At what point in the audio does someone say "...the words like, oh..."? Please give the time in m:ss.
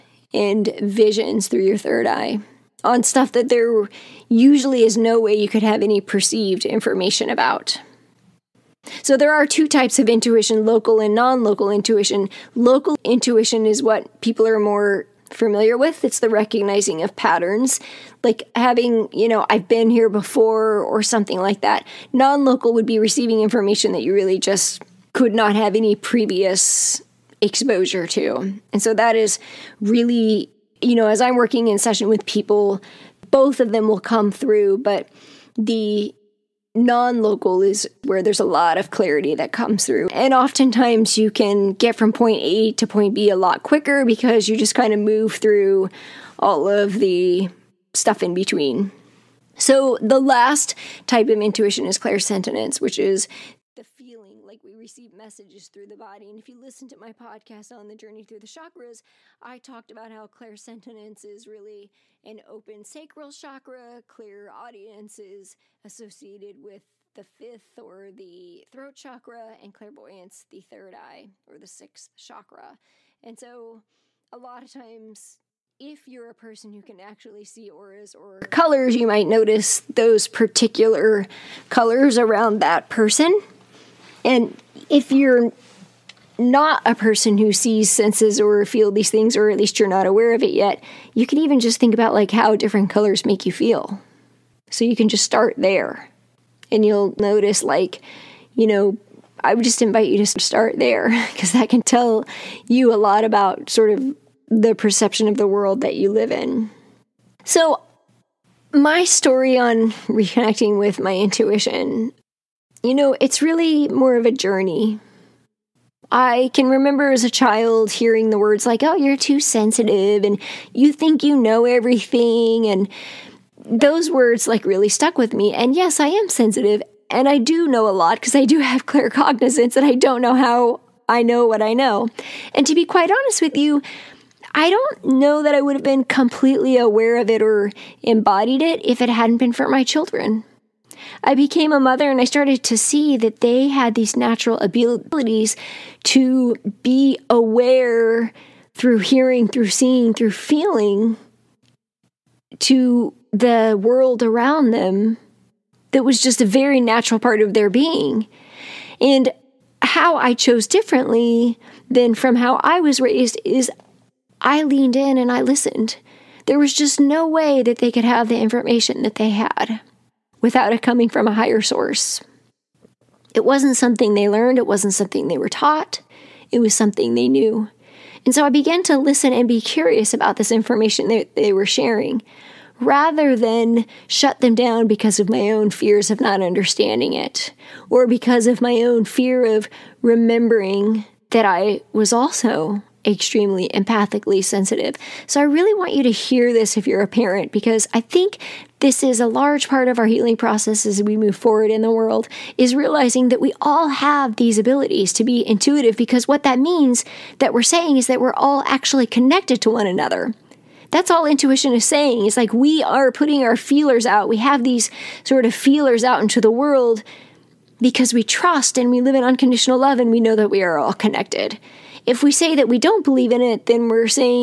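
1:58.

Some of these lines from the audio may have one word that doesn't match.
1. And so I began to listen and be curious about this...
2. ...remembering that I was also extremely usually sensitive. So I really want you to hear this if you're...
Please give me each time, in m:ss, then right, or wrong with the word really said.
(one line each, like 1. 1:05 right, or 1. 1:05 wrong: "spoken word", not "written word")
1. 2:58 right
2. 3:10 wrong: "empathically", not "usually".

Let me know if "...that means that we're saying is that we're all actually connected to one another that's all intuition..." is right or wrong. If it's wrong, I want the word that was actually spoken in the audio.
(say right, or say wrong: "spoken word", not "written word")
right.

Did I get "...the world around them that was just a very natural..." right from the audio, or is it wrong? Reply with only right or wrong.
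right.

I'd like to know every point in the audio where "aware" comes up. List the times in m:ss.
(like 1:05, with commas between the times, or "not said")
1:30, 2:16, 2:27.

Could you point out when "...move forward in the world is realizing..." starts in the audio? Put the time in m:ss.
3:21.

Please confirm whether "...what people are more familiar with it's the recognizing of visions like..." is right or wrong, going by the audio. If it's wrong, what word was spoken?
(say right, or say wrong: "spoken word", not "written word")
wrong: "patterns", not "visions".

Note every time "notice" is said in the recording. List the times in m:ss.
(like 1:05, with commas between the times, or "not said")
1:19, 1:37.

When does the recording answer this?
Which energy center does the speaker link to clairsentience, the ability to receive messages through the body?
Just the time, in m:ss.
1:02.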